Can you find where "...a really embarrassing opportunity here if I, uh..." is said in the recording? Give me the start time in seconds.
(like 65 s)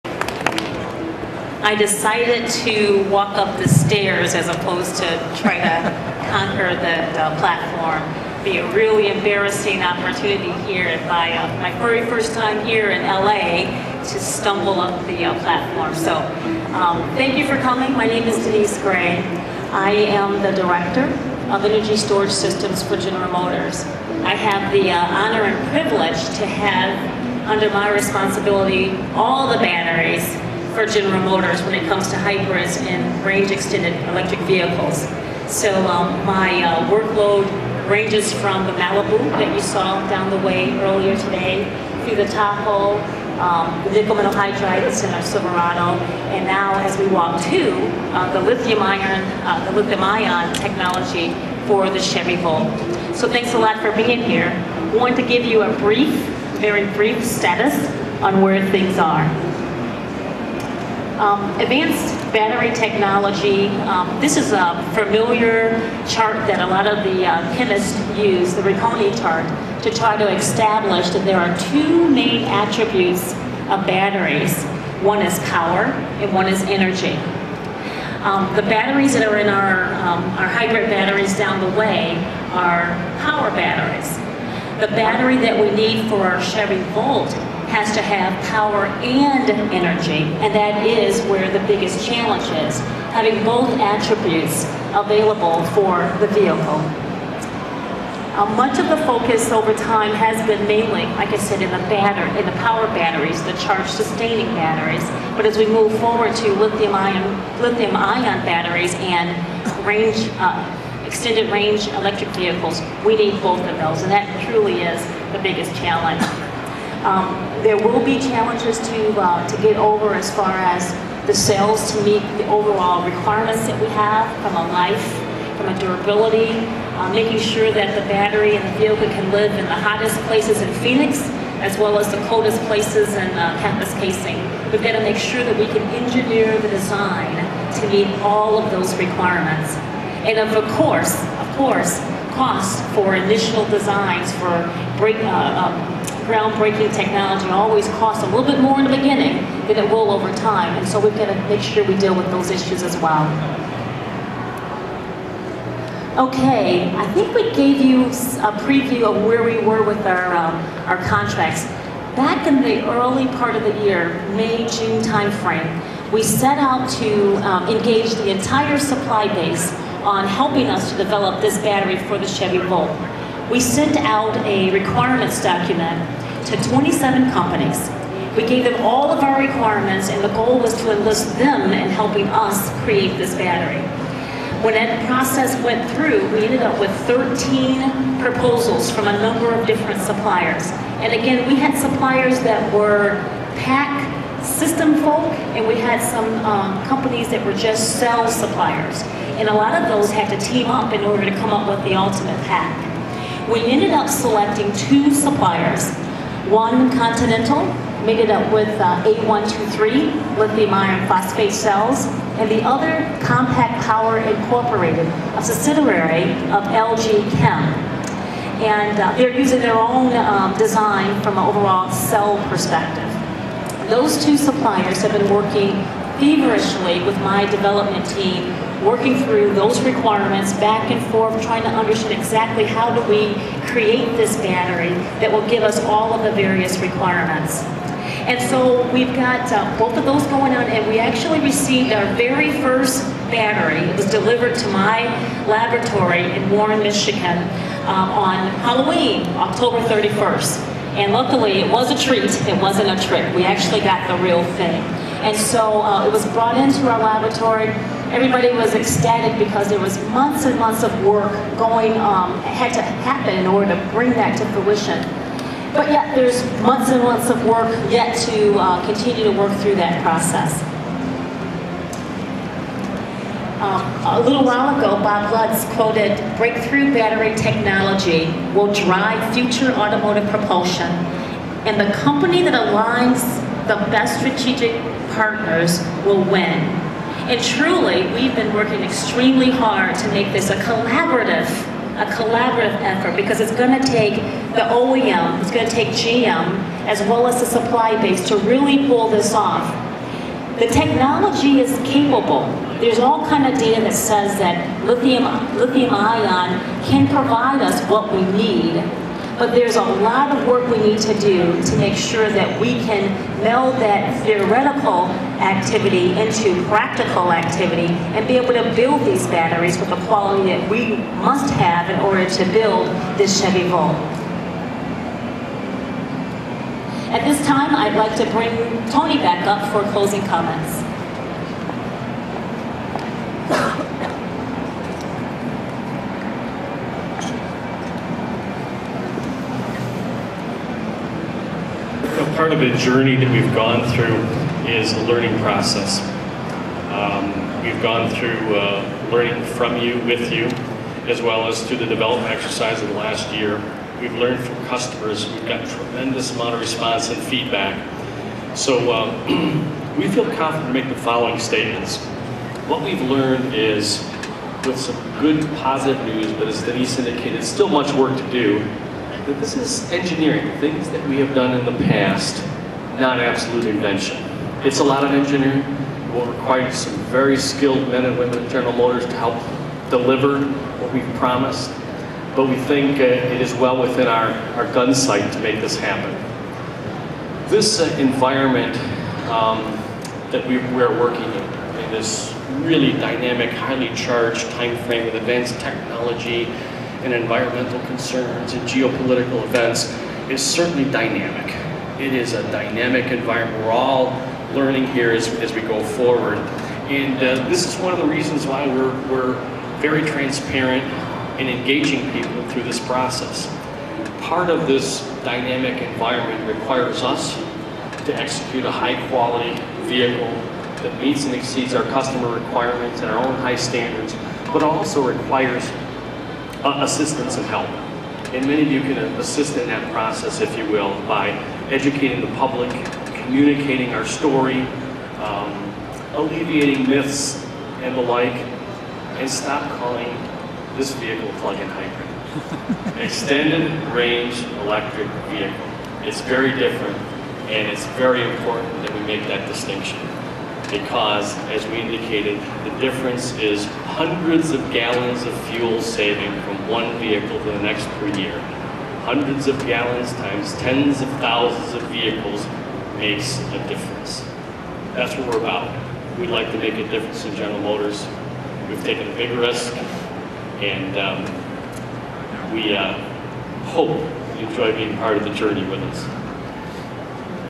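8 s.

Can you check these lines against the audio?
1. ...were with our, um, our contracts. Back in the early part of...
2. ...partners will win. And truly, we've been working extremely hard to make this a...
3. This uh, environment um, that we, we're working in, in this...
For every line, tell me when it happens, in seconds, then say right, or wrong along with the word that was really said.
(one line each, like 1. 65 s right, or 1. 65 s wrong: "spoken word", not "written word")
1. 159 s right
2. 285 s right
3. 387 s right.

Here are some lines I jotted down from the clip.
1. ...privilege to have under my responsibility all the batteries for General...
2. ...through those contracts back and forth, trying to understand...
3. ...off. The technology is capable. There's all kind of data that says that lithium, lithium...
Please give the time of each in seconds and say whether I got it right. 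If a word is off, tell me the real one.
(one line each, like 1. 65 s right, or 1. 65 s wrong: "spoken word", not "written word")
1. 25 s right
2. 229 s wrong: "requirements", not "contracts"
3. 299 s right.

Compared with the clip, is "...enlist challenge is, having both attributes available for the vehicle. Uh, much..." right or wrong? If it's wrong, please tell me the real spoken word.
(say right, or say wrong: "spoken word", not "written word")
wrong: "biggest", not "enlist".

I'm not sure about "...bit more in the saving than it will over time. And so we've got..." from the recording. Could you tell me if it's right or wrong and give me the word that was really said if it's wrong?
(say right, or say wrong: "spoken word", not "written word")
wrong: "beginning", not "saving".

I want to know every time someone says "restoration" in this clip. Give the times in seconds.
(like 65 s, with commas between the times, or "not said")
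not said.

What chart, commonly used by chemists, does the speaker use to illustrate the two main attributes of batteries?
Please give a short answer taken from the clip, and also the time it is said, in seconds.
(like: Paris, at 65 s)
Ragone chart, at 68 s.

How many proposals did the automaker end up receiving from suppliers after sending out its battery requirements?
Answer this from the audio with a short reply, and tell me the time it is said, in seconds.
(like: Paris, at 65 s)
13, at 187 s.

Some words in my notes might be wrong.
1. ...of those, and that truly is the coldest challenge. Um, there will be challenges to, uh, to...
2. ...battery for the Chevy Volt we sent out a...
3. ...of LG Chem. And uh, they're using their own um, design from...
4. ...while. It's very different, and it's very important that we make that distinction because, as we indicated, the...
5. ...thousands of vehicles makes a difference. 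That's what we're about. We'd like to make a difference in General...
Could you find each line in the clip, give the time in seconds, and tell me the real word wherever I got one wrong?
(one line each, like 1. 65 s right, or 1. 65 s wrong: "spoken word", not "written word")
1. 113 s wrong: "biggest", not "coldest"
2. 171 s right
3. 216 s right
4. 445 s wrong: "vehicle", not "while"
5. 461 s right.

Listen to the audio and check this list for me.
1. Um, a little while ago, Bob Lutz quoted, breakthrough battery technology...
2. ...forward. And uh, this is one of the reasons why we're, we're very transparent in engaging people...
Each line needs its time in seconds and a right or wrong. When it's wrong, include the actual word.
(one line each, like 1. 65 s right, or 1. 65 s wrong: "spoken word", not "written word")
1. 273 s right
2. 405 s right.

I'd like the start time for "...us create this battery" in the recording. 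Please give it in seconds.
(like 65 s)
182 s.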